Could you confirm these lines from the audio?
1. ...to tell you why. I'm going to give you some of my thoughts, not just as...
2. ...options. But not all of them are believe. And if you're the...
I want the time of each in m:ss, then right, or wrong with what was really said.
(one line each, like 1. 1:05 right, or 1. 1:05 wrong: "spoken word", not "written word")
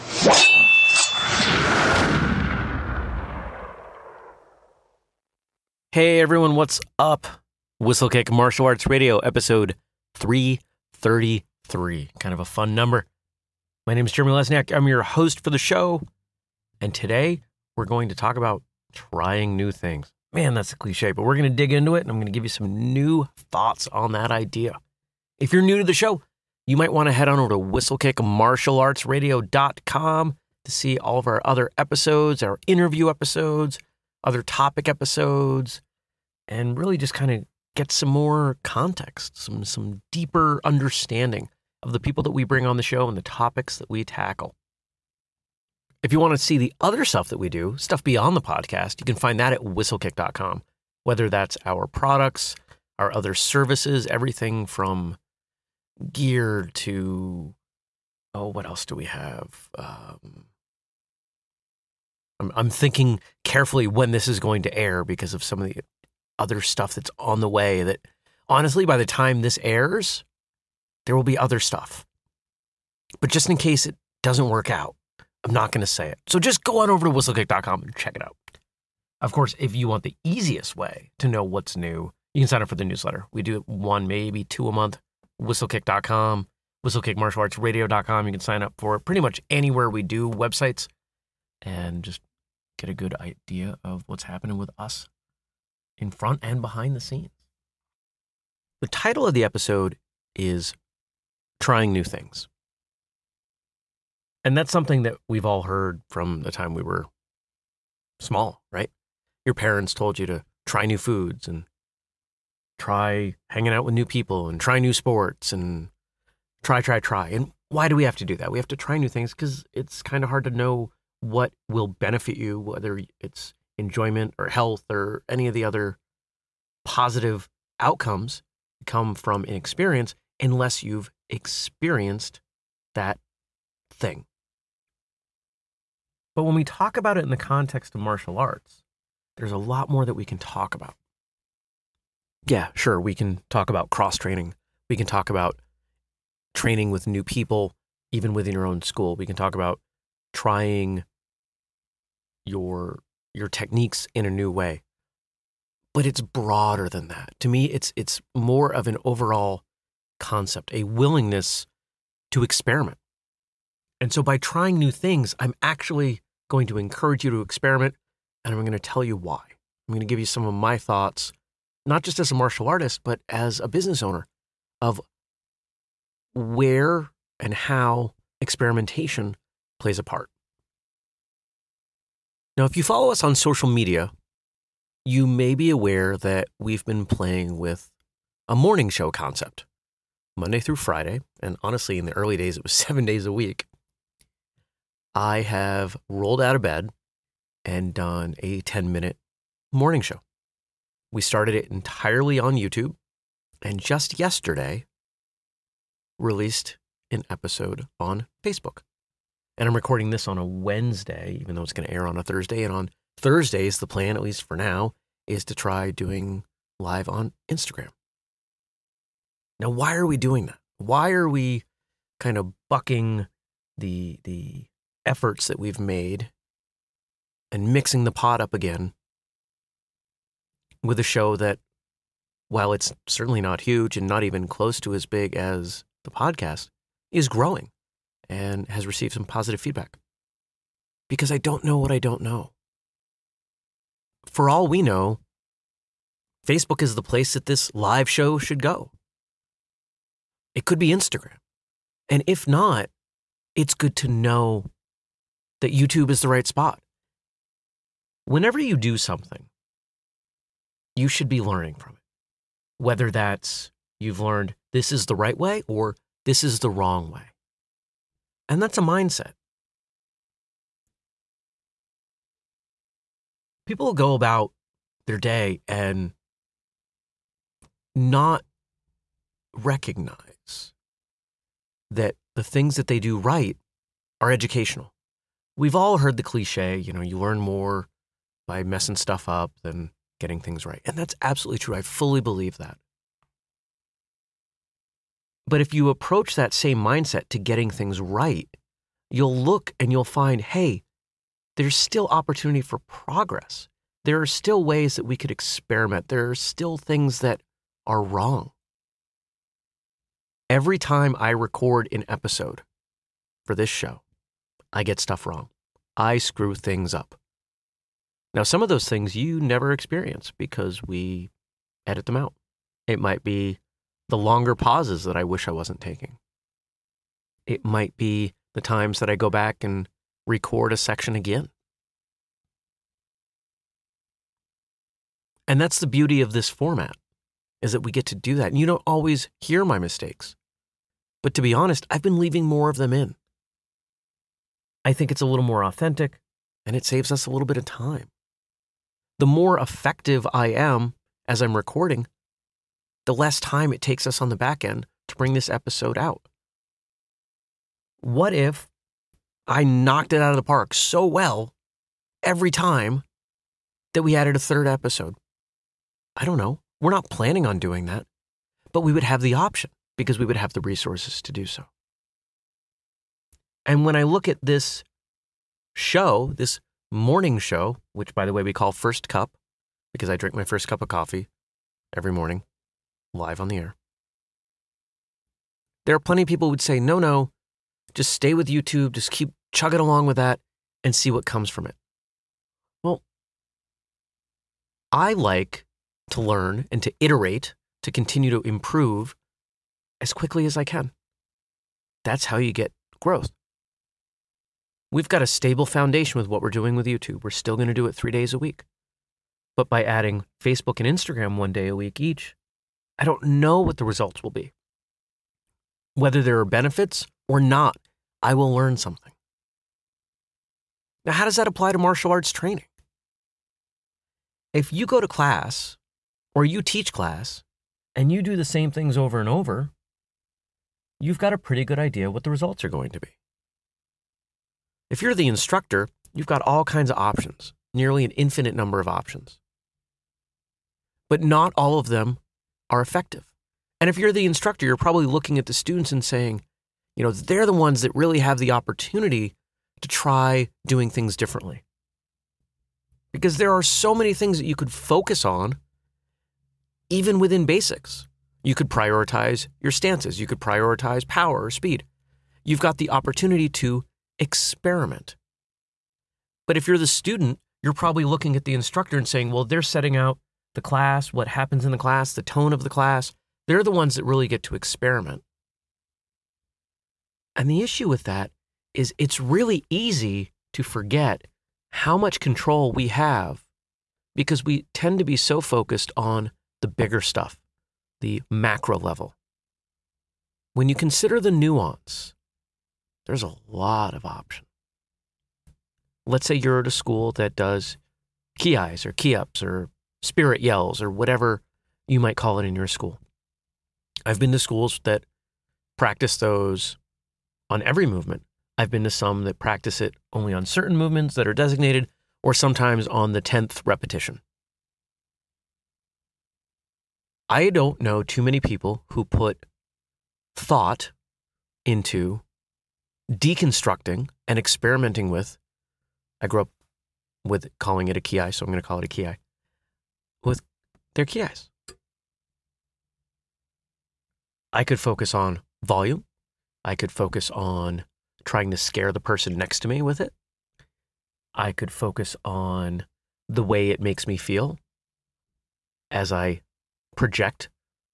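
1. 2:48 right
2. 7:18 wrong: "effective", not "believe".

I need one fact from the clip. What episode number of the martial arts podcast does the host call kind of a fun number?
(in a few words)
333.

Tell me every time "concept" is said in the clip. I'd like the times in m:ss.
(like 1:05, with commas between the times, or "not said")
2:40, 3:09.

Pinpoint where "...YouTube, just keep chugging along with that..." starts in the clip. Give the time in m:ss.
6:28.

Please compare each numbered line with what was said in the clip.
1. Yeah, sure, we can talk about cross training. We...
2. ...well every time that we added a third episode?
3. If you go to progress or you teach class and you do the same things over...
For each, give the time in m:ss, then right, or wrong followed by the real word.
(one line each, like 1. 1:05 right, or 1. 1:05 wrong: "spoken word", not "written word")
1. 2:22 right
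2. 6:01 right
3. 7:04 wrong: "class", not "progress".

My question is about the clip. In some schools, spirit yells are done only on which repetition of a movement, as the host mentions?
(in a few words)
The 10th.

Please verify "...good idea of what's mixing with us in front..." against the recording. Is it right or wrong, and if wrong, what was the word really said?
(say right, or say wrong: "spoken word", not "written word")
wrong: "happening", not "mixing".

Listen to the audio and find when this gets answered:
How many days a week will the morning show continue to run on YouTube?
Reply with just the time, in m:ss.
6:47.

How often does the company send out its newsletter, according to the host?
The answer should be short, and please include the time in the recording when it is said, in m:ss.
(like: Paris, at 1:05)
One, maybe two a month, at 1:23.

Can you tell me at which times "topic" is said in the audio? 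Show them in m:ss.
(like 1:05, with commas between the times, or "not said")
0:34, 0:43.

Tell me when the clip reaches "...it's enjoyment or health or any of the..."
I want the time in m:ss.
2:03.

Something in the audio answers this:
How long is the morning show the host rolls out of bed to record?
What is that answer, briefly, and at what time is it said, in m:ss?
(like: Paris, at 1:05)
10 minutes, at 3:18.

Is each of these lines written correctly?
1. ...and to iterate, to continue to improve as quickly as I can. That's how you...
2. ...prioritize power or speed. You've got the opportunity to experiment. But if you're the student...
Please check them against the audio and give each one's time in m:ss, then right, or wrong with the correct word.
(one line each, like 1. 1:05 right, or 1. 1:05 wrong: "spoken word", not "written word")
1. 6:36 right
2. 7:40 right.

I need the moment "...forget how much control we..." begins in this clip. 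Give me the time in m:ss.
8:00.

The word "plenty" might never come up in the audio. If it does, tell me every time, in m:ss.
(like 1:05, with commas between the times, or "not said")
6:25.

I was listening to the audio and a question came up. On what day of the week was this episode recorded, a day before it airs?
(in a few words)
Wednesday.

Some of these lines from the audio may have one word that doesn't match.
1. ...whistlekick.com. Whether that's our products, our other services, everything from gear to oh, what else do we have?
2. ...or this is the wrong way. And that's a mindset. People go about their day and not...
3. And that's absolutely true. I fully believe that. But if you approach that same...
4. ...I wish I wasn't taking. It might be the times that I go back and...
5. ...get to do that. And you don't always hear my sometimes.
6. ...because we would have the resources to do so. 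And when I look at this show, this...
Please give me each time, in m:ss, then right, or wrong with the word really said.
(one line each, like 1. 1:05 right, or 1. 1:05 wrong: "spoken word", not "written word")
1. 0:49 right
2. 4:25 right
3. 4:50 right
4. 5:25 right
5. 5:37 wrong: "mistakes", not "sometimes"
6. 6:09 right.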